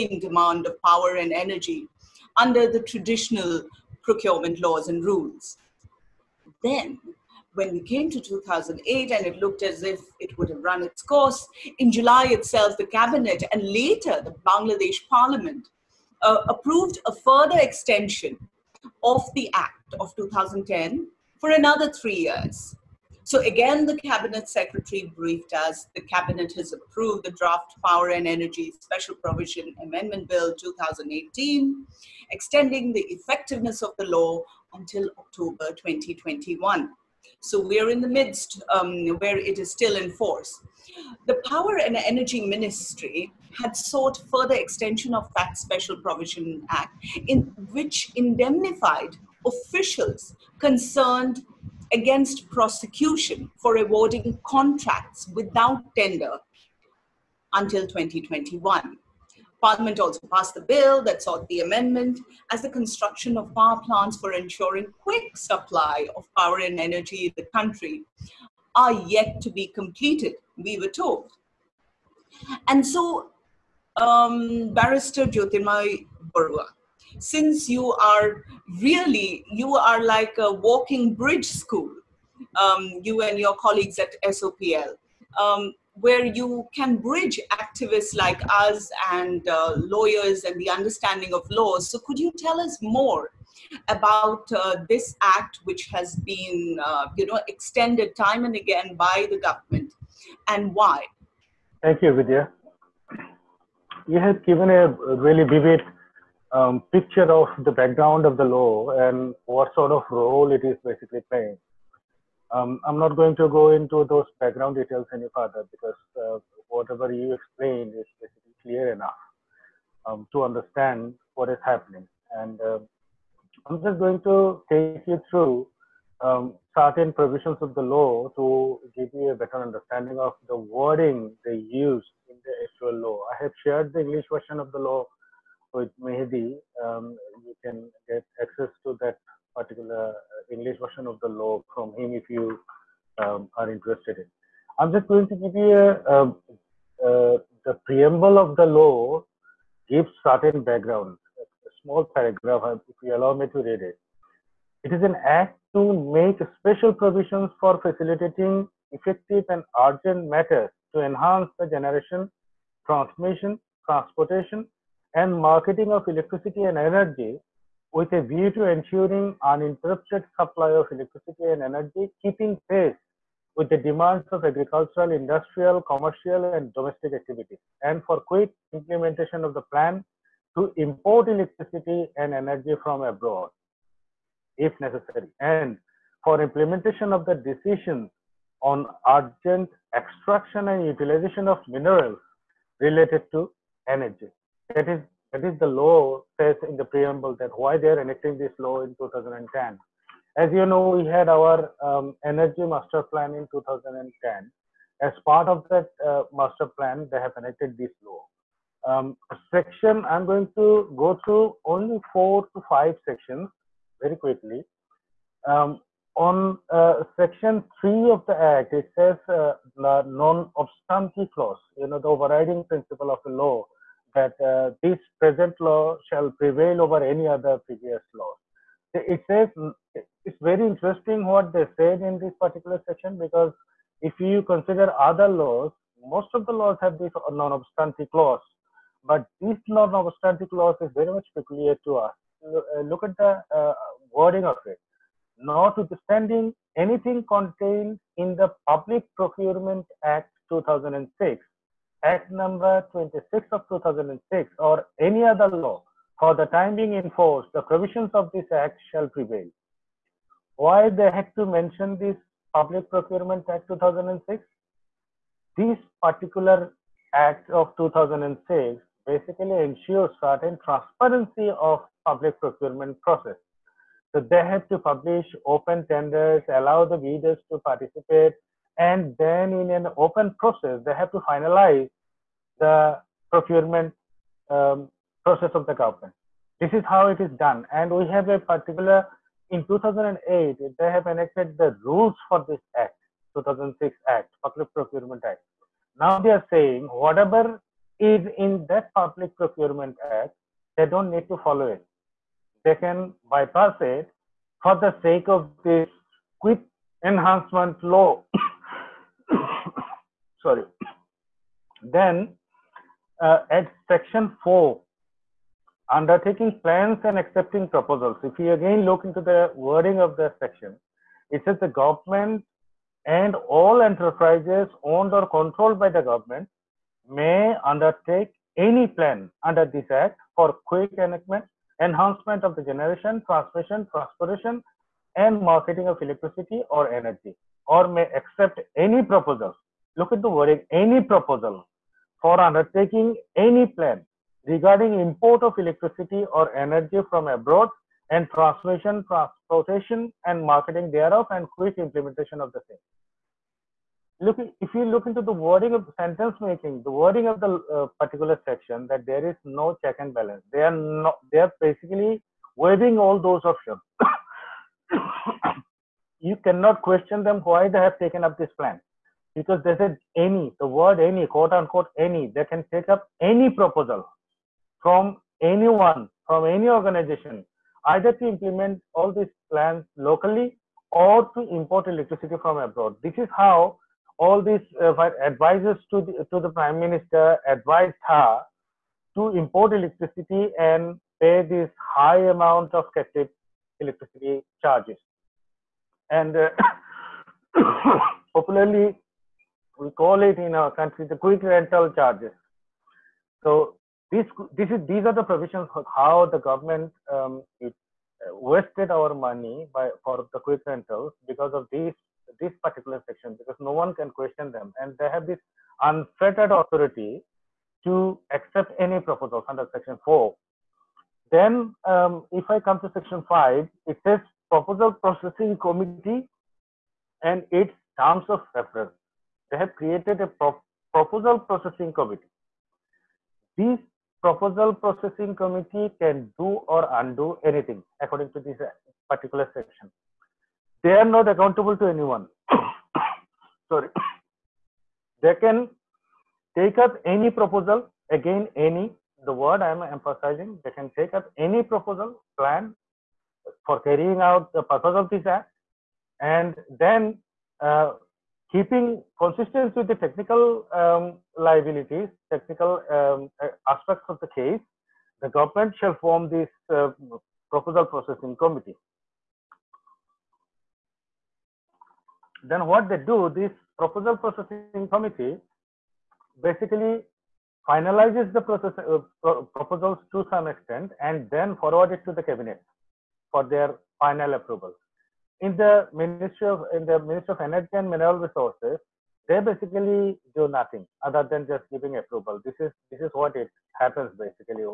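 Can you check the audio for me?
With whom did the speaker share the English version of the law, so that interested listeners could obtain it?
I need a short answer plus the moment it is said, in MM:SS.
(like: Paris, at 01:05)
Mehedi, at 02:16.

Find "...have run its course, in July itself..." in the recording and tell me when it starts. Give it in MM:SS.
00:10.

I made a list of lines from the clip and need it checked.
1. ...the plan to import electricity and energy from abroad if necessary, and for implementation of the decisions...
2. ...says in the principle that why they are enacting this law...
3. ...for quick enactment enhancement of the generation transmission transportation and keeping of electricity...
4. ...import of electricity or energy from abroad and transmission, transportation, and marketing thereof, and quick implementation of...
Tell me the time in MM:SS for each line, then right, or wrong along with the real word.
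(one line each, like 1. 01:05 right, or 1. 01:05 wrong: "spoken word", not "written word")
1. 02:59 right
2. 03:16 wrong: "preamble", not "principle"
3. 05:30 wrong: "marketing", not "keeping"
4. 05:44 right.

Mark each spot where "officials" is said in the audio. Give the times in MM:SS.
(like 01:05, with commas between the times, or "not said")
00:49.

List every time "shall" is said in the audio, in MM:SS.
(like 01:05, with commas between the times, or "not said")
03:46, 04:18, 07:45.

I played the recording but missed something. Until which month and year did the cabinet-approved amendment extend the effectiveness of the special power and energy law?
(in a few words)
October 2021.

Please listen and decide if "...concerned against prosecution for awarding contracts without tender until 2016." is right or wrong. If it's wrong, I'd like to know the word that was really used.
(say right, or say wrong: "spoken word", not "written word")
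wrong: "2021", not "2016".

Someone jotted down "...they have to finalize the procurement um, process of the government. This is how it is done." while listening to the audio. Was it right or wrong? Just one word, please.
right.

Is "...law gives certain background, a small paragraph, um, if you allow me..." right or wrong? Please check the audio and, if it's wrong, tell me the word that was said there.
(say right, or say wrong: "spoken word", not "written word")
right.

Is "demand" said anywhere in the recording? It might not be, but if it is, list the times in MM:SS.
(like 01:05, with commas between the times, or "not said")
00:00, 02:53.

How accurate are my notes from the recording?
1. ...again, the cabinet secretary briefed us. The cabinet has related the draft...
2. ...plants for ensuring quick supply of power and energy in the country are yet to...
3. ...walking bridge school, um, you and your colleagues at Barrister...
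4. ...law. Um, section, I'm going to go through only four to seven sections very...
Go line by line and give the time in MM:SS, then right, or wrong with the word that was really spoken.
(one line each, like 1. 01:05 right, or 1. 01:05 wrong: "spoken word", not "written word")
1. 00:23 wrong: "approved", not "related"
2. 01:03 right
3. 01:20 wrong: "SOPL", not "Barrister"
4. 03:28 wrong: "five", not "seven".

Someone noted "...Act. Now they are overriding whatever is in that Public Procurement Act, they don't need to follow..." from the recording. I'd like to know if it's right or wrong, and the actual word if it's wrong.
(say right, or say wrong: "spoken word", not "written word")
wrong: "saying", not "overriding".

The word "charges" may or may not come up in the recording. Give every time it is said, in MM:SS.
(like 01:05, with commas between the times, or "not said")
06:34, 06:41.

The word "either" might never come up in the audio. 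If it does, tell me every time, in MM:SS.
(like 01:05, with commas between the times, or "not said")
06:17.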